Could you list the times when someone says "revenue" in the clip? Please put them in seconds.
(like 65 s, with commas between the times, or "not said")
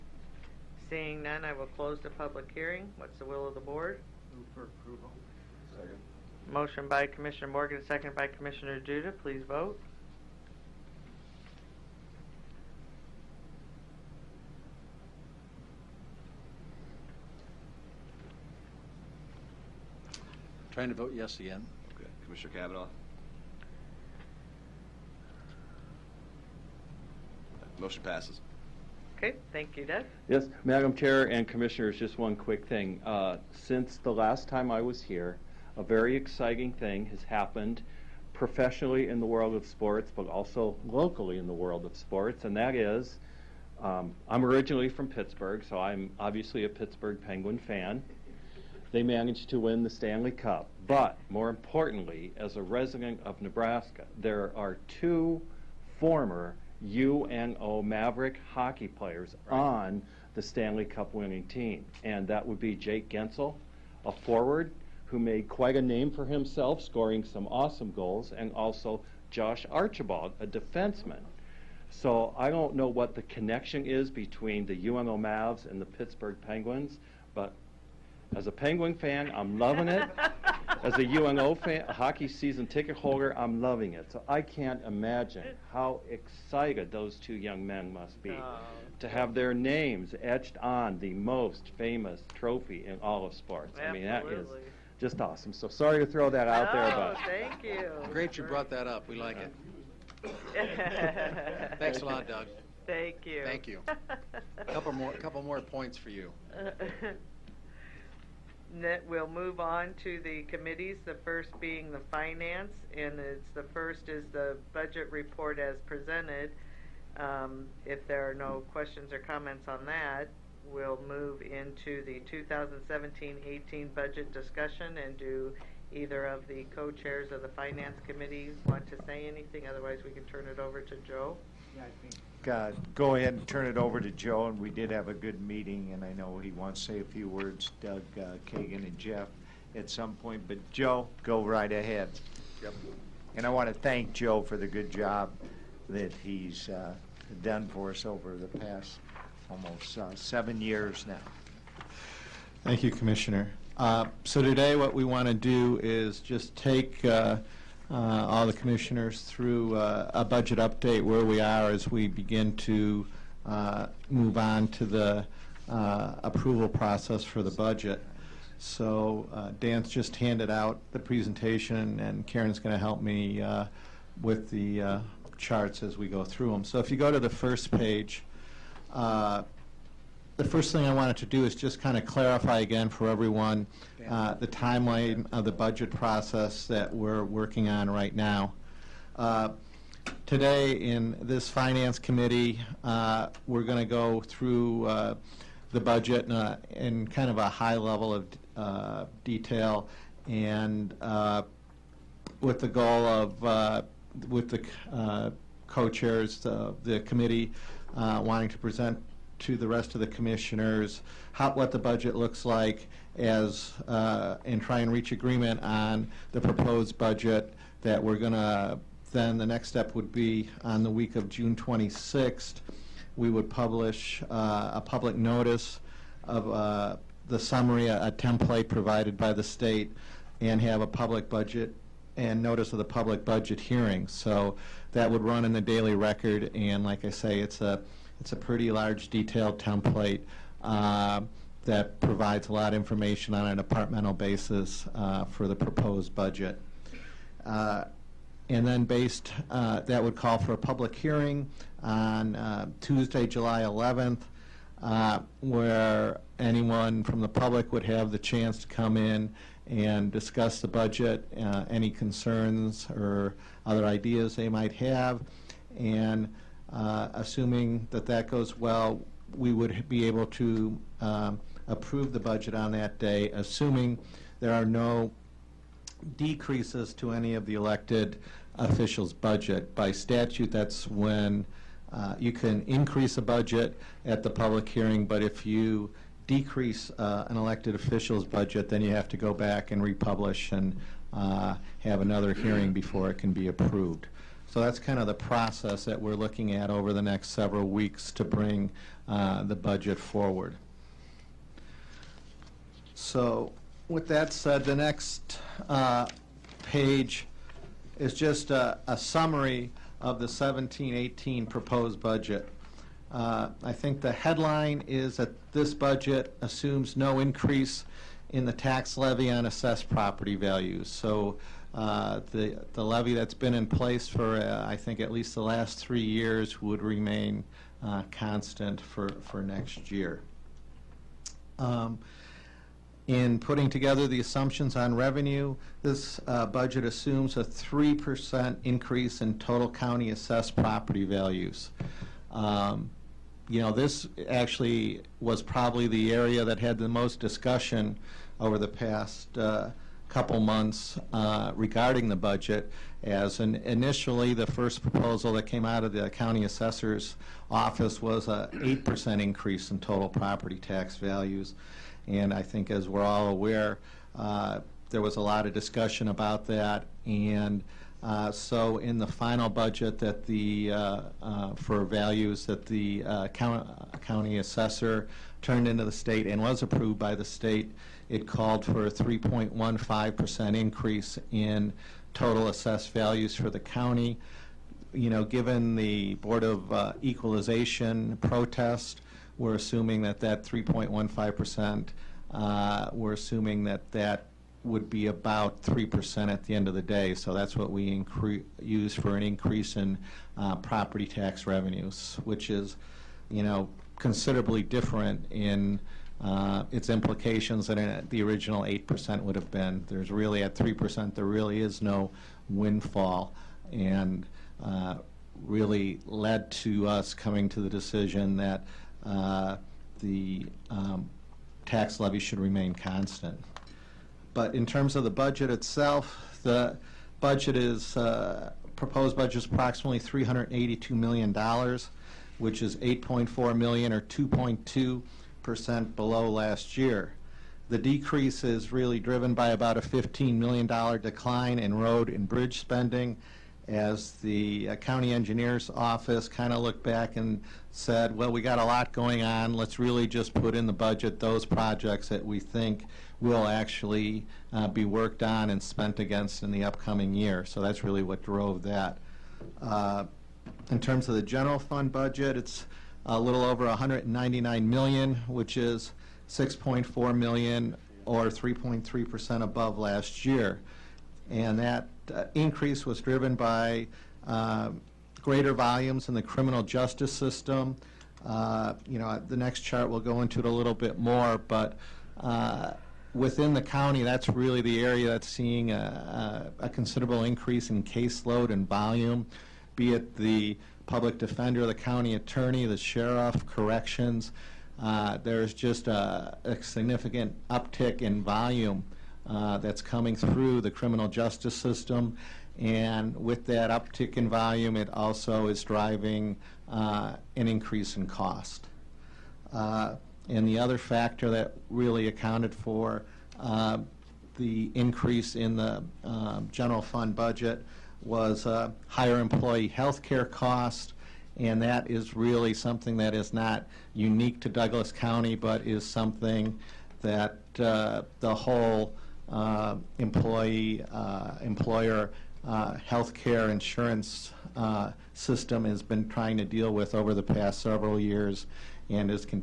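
334 s, 401 s.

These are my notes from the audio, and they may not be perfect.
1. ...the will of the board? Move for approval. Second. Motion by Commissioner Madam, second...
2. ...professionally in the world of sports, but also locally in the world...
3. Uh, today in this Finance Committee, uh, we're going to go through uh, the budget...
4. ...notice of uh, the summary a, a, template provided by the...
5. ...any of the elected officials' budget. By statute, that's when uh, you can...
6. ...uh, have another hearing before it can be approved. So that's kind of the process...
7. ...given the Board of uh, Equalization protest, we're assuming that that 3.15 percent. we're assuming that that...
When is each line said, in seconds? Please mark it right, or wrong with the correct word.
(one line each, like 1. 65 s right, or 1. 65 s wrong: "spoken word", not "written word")
1. 3 s wrong: "Morgan", not "Madam"
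2. 38 s right
3. 189 s right
4. 225 s right
5. 277 s right
6. 291 s right
7. 385 s right.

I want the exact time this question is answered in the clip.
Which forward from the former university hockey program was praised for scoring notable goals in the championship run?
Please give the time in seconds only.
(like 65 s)
62 s.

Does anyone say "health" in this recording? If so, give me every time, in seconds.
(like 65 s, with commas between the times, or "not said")
519 s, 532 s.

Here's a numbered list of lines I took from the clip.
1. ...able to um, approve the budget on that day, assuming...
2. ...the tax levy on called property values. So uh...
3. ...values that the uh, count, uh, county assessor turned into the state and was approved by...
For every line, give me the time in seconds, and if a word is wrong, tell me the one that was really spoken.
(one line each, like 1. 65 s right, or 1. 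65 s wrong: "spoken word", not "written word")
1. 270 s right
2. 318 s wrong: "assessed", not "called"
3. 371 s right.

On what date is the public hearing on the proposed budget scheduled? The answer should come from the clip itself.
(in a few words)
July 11th.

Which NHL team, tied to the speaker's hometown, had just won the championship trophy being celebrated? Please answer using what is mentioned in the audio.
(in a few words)
Pittsburgh Penguins.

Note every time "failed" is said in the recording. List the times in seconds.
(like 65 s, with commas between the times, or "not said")
not said.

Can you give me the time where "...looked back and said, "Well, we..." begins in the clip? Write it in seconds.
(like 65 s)
446 s.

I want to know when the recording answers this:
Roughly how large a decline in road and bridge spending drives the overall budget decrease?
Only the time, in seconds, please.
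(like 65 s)
439 s.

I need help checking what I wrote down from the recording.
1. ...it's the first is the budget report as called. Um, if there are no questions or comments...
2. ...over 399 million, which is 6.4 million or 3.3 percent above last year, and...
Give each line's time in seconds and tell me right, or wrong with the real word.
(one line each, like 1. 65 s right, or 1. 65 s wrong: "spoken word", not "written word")
1. 113 s wrong: "presented", not "called"
2. 463 s wrong: "199", not "399".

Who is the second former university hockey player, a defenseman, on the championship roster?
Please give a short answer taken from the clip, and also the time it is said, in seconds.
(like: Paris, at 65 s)
Josh Archibald, at 69 s.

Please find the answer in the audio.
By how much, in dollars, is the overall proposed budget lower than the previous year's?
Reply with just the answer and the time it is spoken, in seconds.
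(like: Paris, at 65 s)
8.4 million, at 432 s.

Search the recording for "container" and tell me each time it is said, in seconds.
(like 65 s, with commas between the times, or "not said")
not said.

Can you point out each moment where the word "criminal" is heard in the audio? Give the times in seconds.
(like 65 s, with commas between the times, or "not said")
476 s, 500 s.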